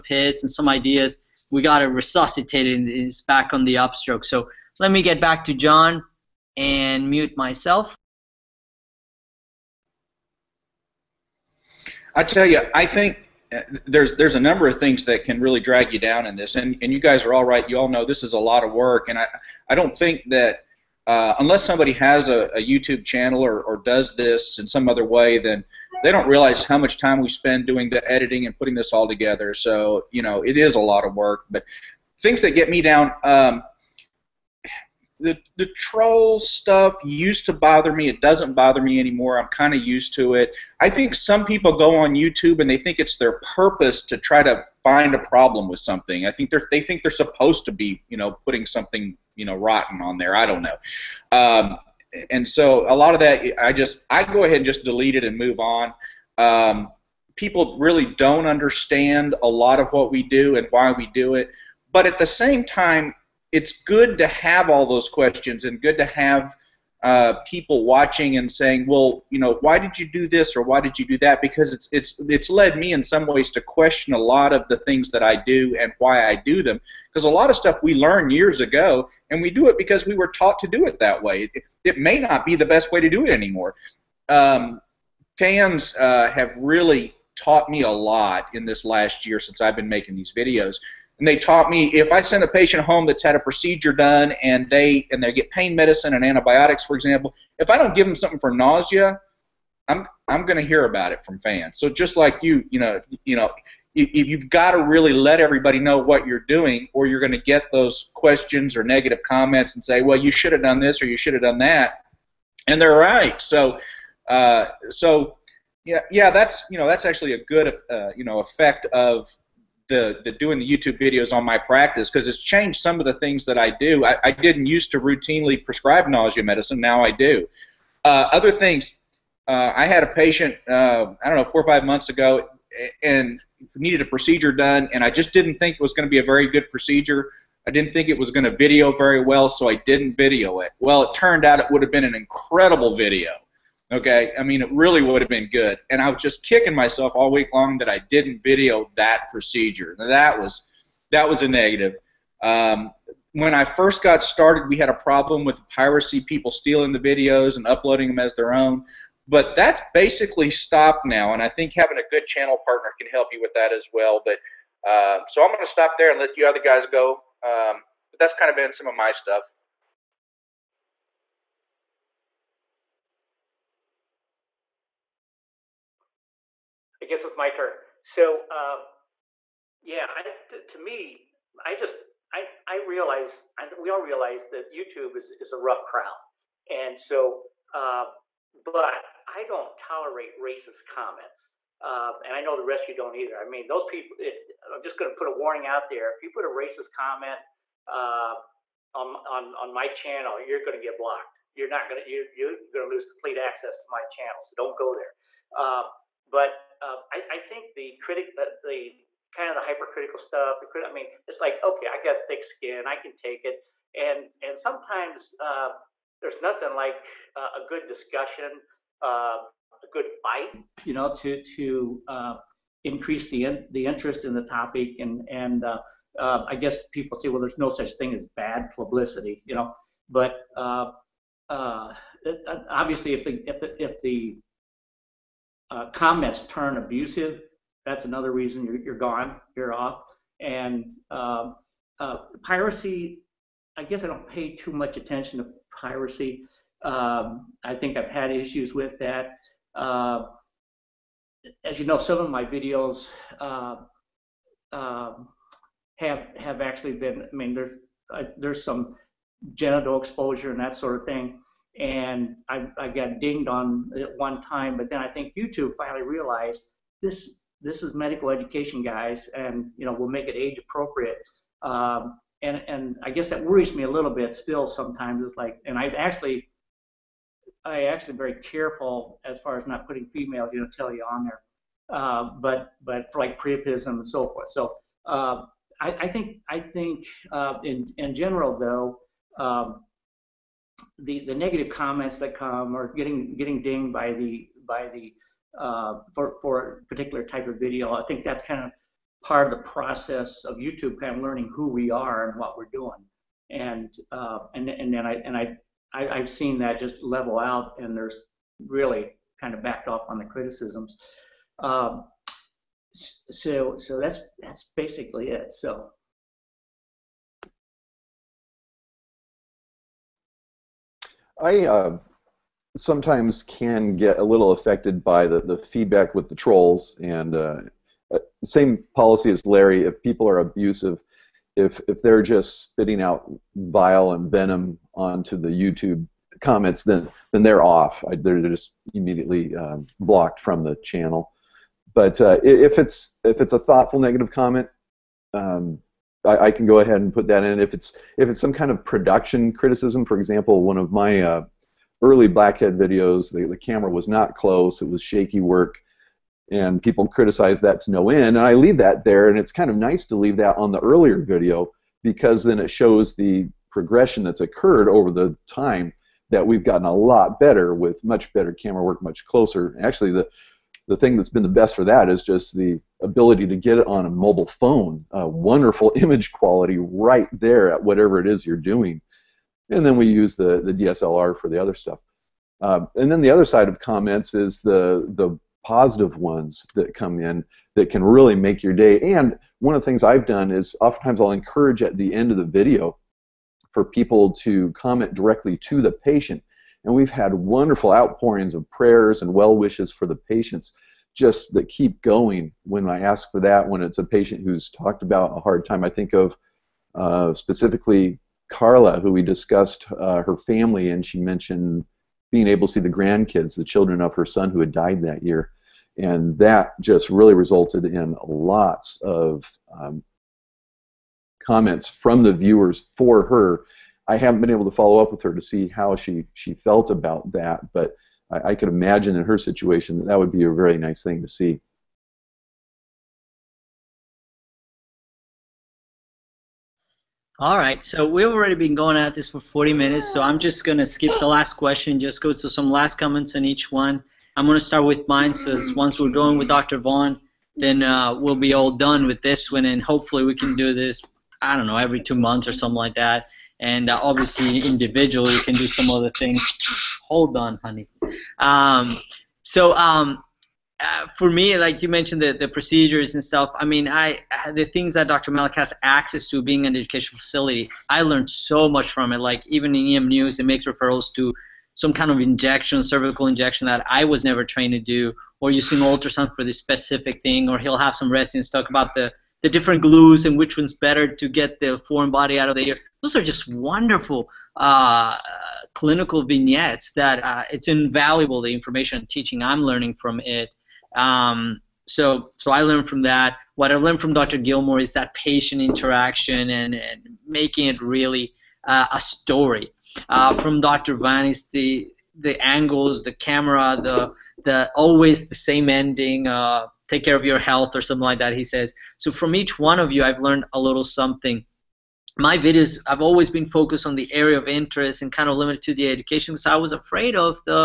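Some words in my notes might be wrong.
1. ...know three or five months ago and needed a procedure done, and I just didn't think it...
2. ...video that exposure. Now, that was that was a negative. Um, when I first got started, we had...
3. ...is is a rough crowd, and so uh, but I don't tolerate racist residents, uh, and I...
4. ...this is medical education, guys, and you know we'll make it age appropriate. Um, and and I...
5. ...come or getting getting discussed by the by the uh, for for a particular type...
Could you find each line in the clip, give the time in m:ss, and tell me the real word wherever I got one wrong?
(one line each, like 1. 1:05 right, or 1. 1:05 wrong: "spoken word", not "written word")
1. 2:11 wrong: "four", not "three"
2. 2:28 wrong: "procedure", not "exposure"
3. 3:05 wrong: "comments", not "residents"
4. 4:27 right
5. 4:52 wrong: "dinged", not "discussed".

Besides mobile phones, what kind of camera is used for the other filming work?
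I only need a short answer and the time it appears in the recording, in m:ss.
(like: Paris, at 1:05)
DSLR, at 6:20.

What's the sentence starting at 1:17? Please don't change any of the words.
Because a lot of stuff we learn years ago, and we do it because we were taught to do it that way.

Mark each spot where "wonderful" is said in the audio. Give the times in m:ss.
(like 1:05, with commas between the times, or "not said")
6:15, 6:37, 8:03.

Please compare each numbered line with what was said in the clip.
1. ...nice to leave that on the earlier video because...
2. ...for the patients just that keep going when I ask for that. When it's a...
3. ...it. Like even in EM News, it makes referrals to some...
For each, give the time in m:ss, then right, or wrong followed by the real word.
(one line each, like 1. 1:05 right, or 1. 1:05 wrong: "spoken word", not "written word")
1. 5:59 right
2. 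6:39 right
3. 7:49 right.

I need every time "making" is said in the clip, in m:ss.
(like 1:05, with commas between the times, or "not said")
1:29, 8:17.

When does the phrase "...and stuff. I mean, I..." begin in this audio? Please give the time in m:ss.
7:43.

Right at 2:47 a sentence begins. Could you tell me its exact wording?
Um, but that's kind of been some of my stuff.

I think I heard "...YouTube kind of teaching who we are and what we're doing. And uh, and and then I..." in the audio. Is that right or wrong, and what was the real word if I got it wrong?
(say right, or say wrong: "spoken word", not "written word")
wrong: "learning", not "teaching".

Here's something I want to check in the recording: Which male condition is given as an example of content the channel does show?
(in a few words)
priapism.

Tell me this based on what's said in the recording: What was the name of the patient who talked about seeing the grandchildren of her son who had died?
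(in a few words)
Carla.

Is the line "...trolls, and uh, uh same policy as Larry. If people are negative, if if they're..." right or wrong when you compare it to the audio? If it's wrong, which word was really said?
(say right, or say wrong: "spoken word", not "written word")
wrong: "abusive", not "negative".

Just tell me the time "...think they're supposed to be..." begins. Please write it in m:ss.
0:46.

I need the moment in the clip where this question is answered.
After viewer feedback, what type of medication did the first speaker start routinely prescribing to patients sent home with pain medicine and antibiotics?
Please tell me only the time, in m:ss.
2:06.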